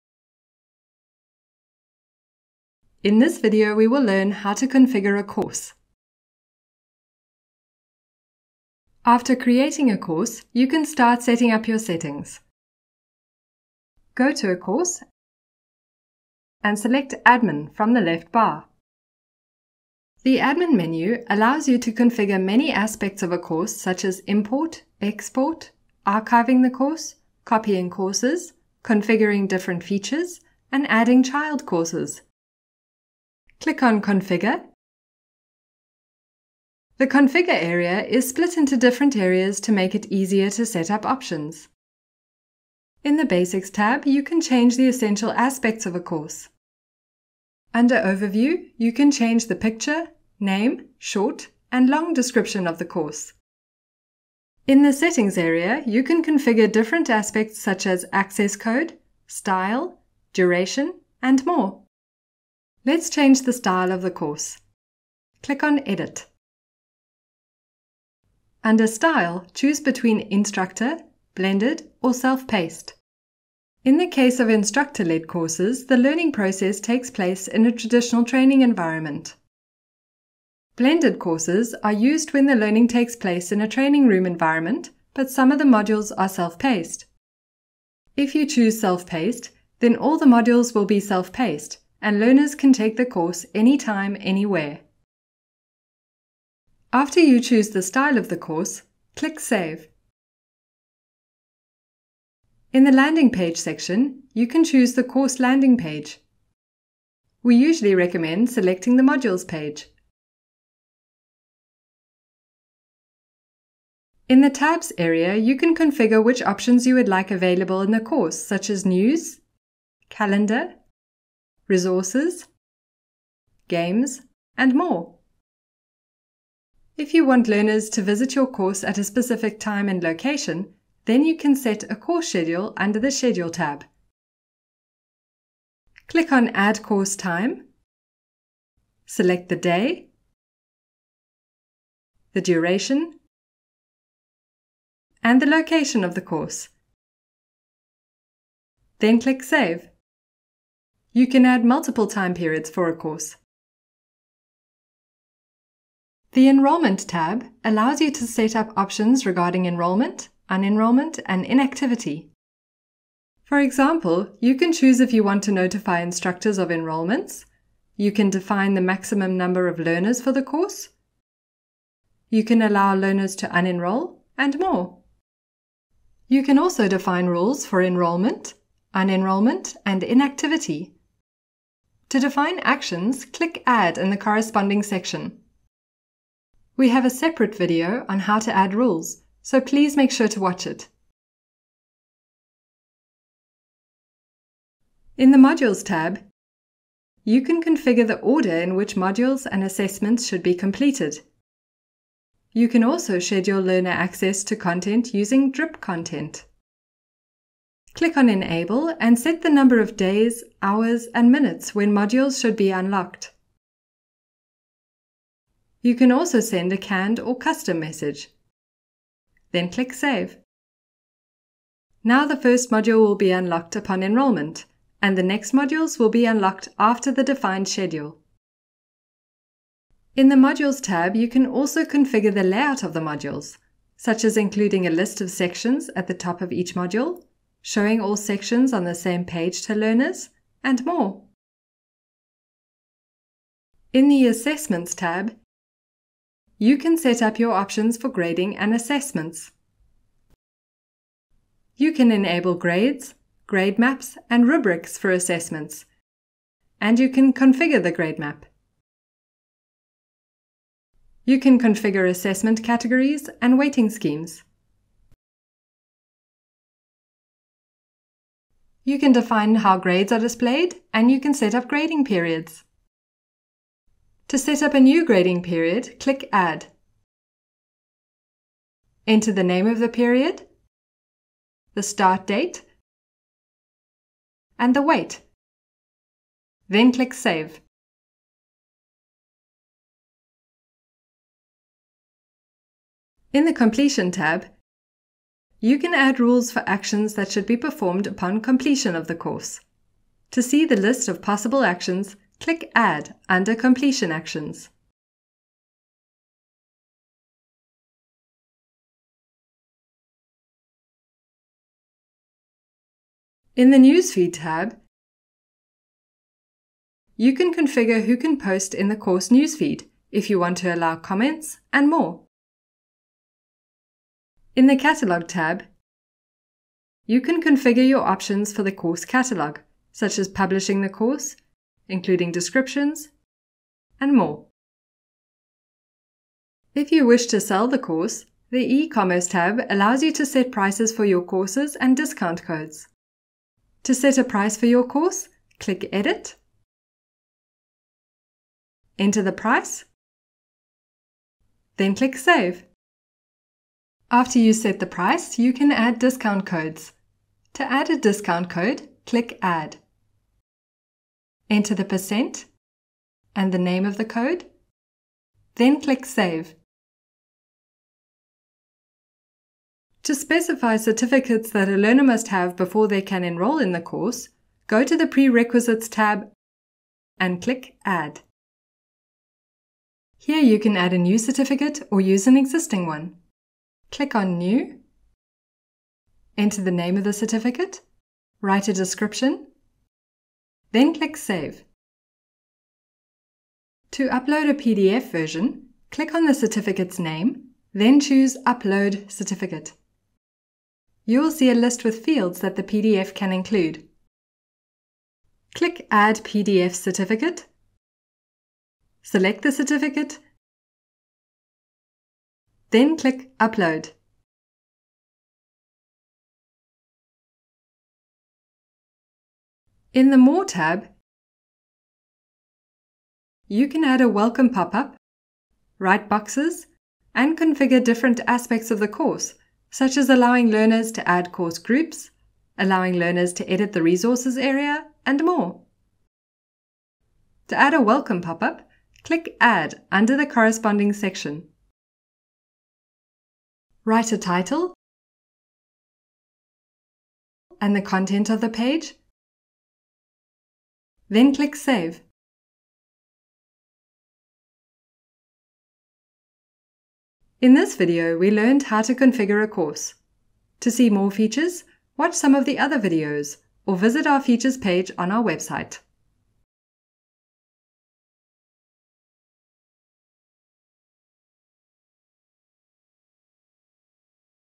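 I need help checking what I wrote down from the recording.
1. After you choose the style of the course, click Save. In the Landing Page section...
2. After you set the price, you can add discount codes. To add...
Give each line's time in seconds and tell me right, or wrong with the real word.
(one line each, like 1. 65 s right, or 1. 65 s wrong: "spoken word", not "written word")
1. 96 s right
2. 354 s right.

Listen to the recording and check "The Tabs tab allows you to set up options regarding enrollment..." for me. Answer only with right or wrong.
wrong.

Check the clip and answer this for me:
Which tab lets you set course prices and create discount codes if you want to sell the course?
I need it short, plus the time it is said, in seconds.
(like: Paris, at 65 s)
e-commerce, at 338 s.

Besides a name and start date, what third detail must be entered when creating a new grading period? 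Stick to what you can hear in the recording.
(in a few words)
the weight.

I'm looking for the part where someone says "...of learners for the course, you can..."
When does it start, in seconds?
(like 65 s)
169 s.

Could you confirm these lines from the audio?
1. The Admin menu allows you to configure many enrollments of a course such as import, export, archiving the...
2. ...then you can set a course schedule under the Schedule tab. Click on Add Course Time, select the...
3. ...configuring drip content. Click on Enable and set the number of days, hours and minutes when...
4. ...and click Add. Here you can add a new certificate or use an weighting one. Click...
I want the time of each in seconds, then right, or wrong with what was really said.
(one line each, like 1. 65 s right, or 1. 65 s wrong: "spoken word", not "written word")
1. 20 s wrong: "aspects", not "enrollments"
2. 131 s right
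3. 205 s wrong: "using", not "configuring"
4. 377 s wrong: "existing", not "weighting".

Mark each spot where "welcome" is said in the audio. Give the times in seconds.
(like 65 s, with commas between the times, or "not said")
424 s, 437 s.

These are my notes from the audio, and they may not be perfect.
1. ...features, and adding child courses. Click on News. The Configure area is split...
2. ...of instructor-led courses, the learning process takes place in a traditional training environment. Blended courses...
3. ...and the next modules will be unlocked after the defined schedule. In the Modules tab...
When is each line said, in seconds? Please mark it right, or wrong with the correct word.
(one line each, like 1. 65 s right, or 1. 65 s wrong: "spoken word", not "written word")
1. 29 s wrong: "Configure", not "News"
2. 74 s right
3. 225 s right.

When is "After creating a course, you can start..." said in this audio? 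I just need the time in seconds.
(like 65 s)
9 s.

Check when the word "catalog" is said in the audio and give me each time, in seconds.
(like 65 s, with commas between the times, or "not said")
324 s, 329 s.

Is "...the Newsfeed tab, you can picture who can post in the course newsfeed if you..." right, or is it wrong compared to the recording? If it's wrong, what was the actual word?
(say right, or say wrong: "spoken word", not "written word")
wrong: "configure", not "picture".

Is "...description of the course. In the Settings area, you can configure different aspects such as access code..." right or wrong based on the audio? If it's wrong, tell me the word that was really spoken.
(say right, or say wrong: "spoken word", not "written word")
right.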